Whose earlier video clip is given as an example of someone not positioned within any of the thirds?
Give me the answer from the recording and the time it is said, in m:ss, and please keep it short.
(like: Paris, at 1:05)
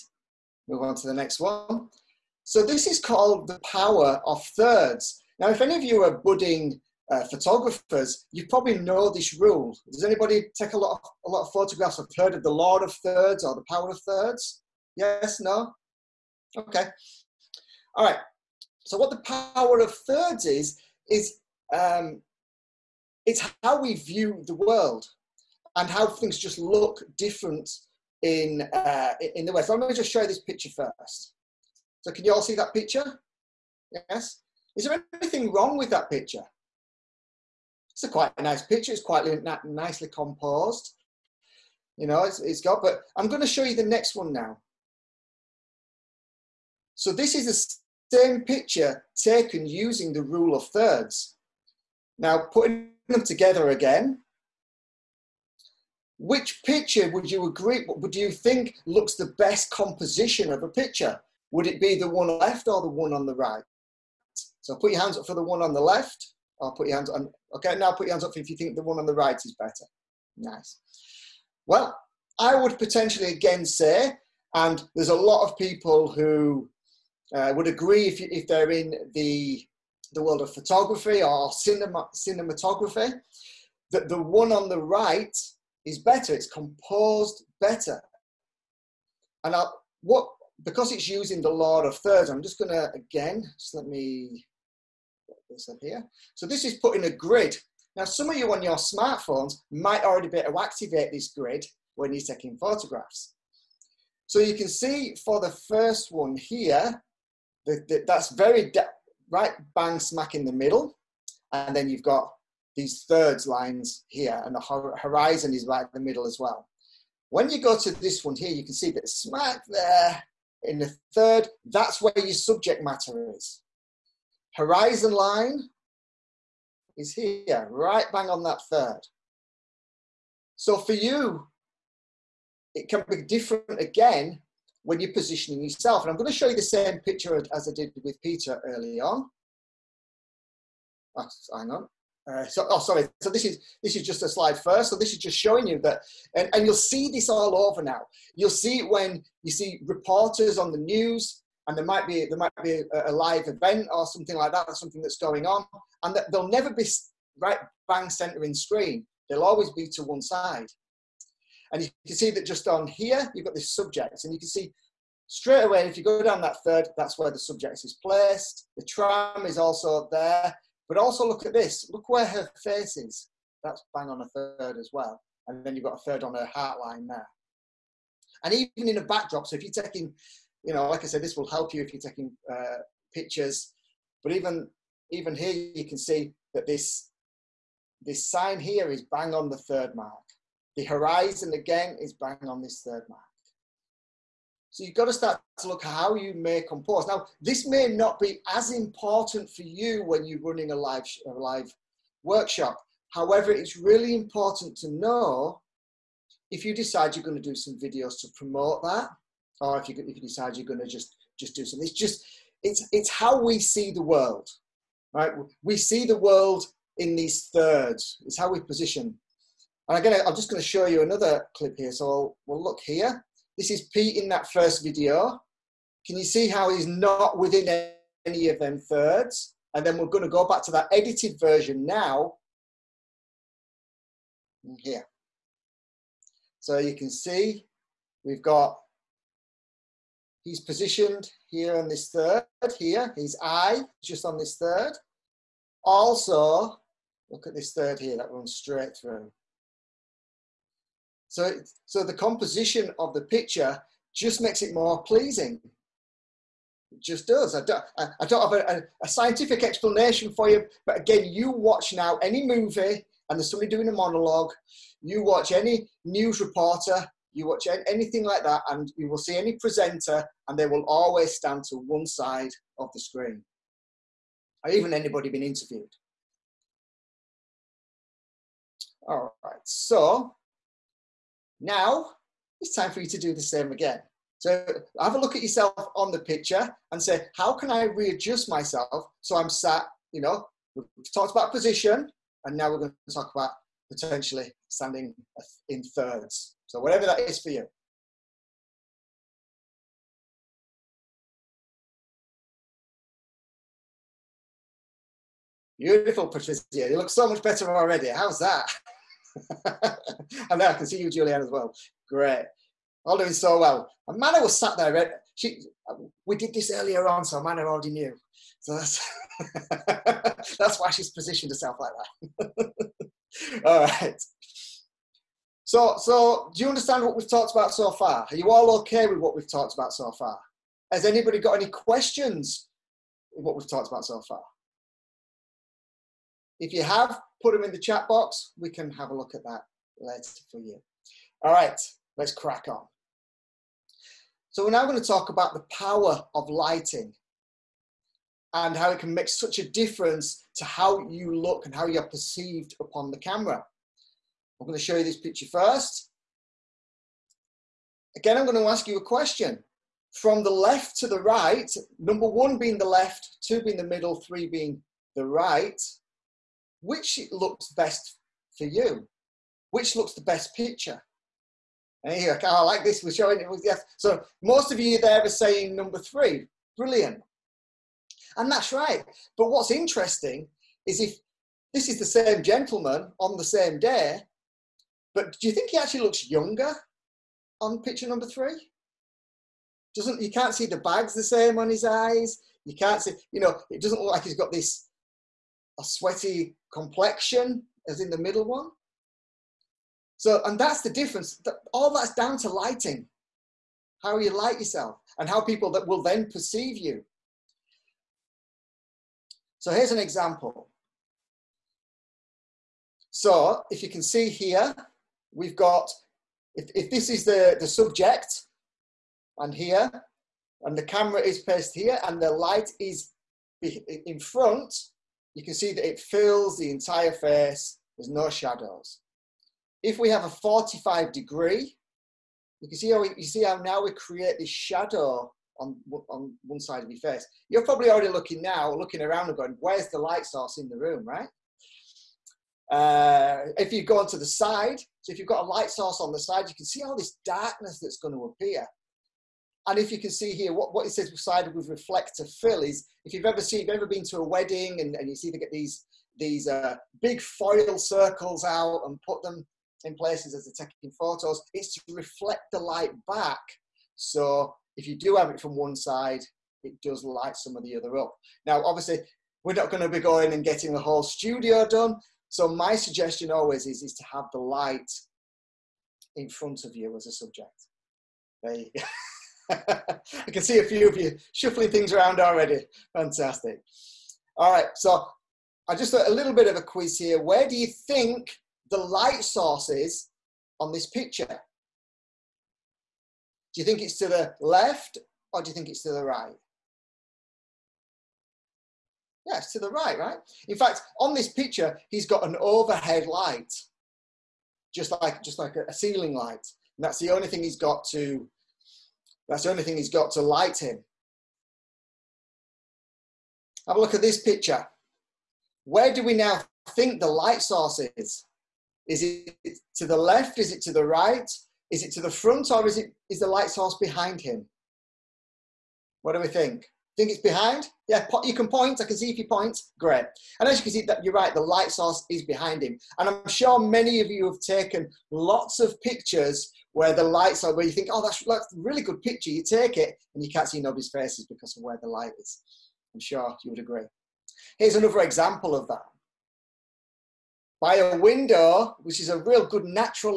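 Pete, at 3:43.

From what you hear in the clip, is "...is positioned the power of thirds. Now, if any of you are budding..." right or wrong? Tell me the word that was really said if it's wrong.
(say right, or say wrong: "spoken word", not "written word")
wrong: "called", not "positioned".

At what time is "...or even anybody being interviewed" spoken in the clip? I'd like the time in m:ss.
4:34.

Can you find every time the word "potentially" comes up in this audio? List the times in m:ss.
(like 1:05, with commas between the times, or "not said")
1:12, 4:53.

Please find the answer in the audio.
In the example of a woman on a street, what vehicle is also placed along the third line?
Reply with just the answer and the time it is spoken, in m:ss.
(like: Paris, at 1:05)
tram, at 2:48.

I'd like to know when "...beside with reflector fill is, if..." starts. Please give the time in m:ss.
7:31.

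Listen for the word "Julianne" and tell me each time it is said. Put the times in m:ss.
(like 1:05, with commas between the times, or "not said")
5:11.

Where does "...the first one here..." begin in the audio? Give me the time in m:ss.
1:45.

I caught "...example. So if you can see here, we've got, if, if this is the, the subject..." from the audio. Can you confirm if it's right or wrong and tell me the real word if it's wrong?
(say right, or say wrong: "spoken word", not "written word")
right.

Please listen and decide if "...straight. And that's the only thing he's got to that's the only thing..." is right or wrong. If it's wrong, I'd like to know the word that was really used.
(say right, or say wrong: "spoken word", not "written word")
wrong: "light", not "straight".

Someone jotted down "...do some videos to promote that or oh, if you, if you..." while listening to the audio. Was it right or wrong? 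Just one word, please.
right.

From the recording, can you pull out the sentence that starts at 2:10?
So for you, it can be different again when you're positioning yourself.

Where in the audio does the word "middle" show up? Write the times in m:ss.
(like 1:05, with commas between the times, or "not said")
1:50, 1:56, 6:03, 6:38.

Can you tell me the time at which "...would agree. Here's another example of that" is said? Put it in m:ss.
9:03.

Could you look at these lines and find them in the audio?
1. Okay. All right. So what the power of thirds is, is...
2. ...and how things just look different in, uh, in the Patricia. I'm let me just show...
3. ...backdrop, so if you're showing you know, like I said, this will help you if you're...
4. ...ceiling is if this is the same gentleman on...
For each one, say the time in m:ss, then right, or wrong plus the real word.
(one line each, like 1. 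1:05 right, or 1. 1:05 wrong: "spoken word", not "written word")
1. 0:16 right
2. 0:25 wrong: "West", not "Patricia"
3. 2:59 wrong: "taking", not "showing"
4. 6:19 wrong: "interesting", not "ceiling".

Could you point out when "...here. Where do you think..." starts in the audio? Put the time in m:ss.
8:06.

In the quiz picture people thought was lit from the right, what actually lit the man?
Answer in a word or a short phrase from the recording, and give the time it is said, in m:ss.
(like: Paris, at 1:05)
an overhead light, at 8:22.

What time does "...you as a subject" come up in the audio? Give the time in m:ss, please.
7:56.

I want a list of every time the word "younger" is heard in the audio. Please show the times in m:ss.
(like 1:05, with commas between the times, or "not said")
6:26.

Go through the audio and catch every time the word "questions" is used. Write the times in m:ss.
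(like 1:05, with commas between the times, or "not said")
5:31, 5:59.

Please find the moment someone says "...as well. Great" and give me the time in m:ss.
5:11.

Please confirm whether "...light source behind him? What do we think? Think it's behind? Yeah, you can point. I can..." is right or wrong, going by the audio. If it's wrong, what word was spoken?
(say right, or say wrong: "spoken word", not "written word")
right.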